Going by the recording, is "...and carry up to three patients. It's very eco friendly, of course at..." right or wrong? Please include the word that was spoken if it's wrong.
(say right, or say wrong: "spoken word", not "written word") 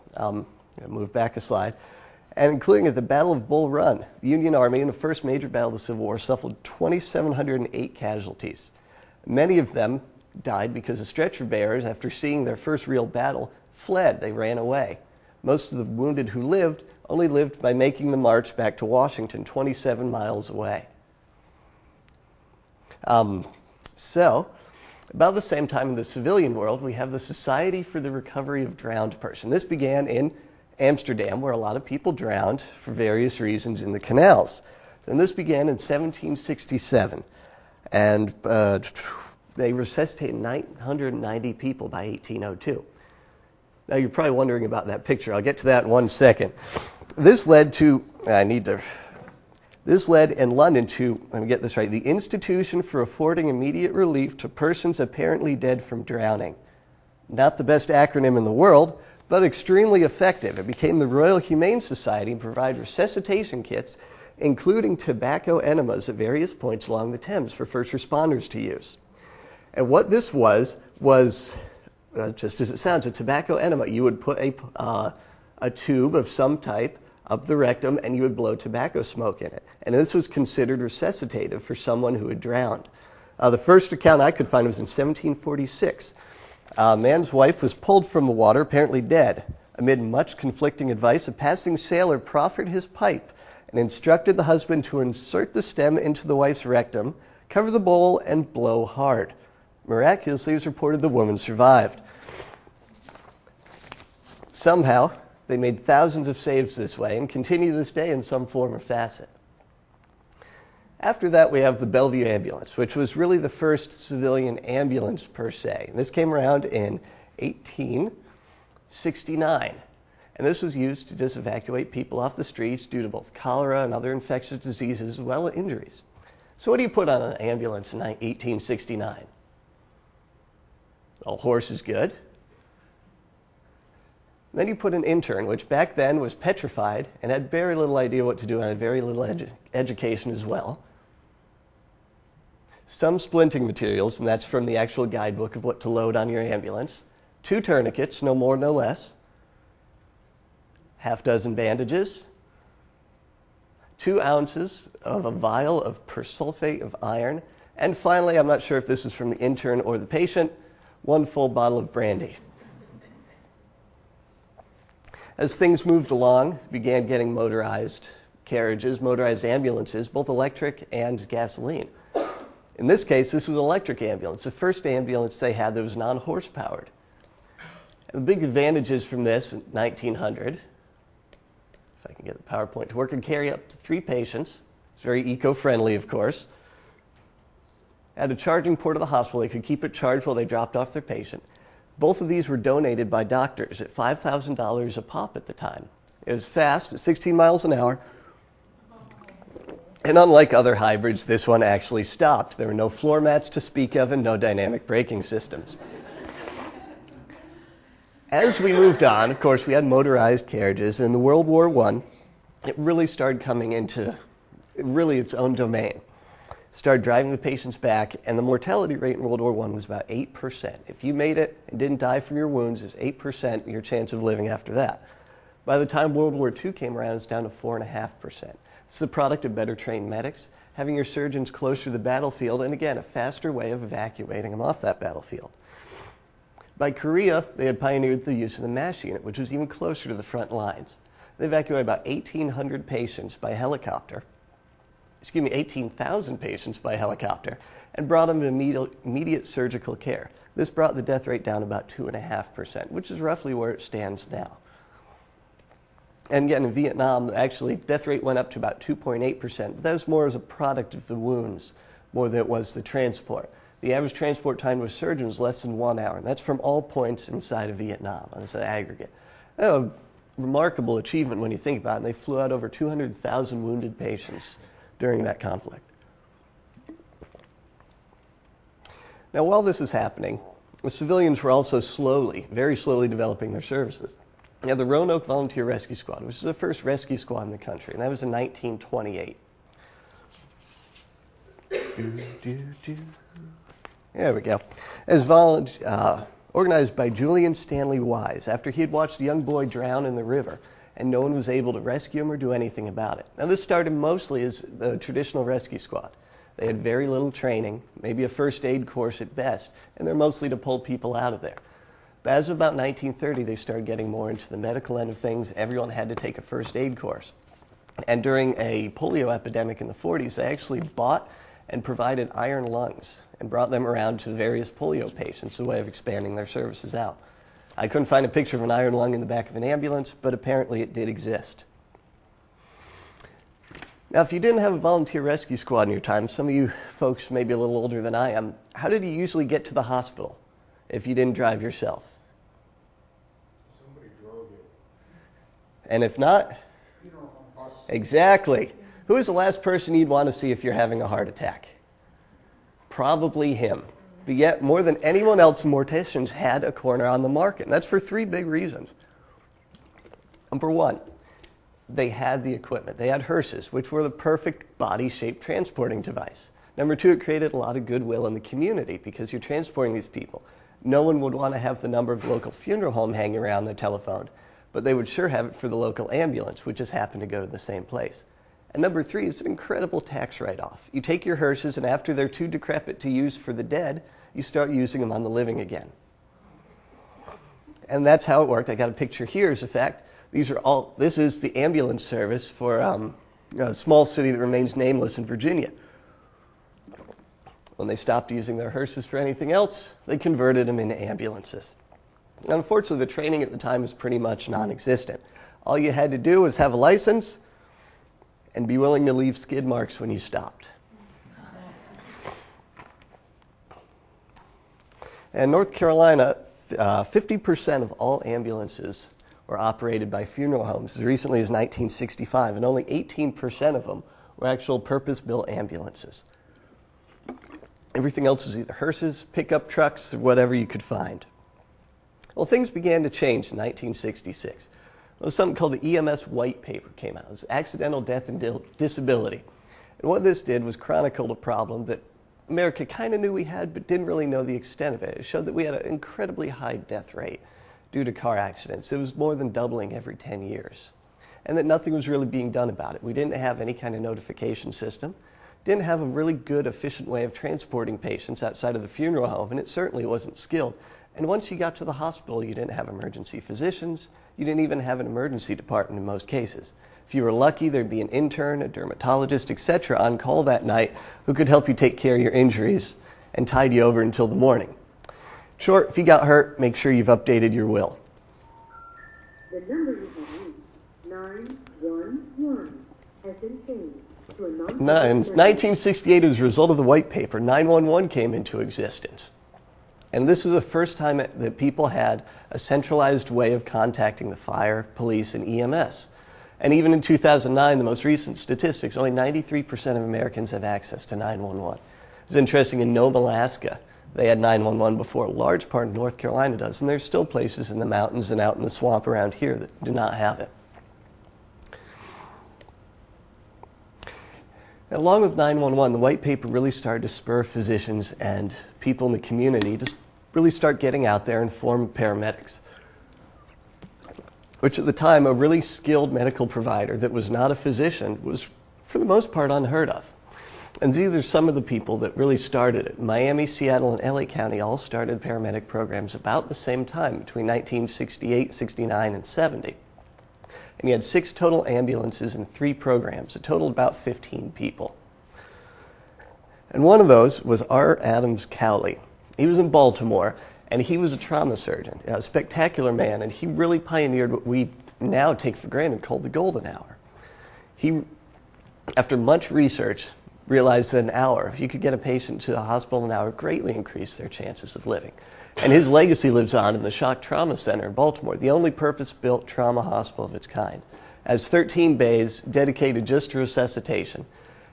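right.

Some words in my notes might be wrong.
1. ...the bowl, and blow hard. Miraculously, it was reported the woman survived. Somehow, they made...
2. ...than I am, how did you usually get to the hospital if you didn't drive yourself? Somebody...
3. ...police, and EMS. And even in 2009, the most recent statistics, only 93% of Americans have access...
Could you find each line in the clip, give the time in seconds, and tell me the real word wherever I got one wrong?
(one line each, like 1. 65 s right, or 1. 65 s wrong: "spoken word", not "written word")
1. 97 s right
2. 338 s right
3. 494 s right.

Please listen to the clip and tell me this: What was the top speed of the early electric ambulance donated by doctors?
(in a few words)
16 miles an hour.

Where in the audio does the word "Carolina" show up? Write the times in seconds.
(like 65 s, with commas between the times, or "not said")
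415 s, 506 s.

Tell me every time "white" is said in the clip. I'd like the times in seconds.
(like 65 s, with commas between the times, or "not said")
436 s, 486 s, 515 s.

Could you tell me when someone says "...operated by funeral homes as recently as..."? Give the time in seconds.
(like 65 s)
419 s.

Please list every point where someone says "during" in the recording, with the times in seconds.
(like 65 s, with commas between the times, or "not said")
274 s, 318 s.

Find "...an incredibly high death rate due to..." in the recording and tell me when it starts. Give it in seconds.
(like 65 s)
445 s.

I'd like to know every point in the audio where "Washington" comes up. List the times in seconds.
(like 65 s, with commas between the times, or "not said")
18 s.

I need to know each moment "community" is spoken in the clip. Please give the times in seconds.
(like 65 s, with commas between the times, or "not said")
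368 s, 519 s.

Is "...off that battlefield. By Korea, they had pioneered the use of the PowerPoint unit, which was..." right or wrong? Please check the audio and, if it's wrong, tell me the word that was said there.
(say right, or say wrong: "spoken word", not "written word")
wrong: "MASH", not "PowerPoint".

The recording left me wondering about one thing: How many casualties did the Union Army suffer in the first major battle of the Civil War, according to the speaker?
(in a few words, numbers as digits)
2,708.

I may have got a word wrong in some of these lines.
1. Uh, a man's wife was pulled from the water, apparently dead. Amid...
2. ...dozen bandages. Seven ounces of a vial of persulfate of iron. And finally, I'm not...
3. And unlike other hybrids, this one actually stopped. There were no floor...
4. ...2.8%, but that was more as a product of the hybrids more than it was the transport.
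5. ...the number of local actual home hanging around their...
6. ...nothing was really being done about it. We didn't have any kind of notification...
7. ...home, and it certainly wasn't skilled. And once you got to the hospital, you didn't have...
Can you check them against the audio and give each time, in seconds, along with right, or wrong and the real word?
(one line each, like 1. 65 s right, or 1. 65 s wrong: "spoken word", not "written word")
1. 86 s right
2. 151 s wrong: "Two", not "Seven"
3. 200 s right
4. 258 s wrong: "wounds", not "hybrids"
5. 371 s wrong: "funeral", not "actual"
6. 451 s right
7. 459 s right.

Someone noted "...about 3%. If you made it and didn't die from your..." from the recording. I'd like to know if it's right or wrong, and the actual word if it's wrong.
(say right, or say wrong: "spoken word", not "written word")
wrong: "8", not "3".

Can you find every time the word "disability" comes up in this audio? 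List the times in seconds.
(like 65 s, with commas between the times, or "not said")
438 s.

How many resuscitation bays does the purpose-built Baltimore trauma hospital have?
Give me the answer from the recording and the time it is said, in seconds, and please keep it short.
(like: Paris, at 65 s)
13, at 571 s.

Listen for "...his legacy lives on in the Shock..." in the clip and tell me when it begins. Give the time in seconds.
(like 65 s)
565 s.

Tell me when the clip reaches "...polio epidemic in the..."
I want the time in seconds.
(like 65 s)
318 s.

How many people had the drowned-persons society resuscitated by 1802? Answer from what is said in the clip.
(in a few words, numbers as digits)
990.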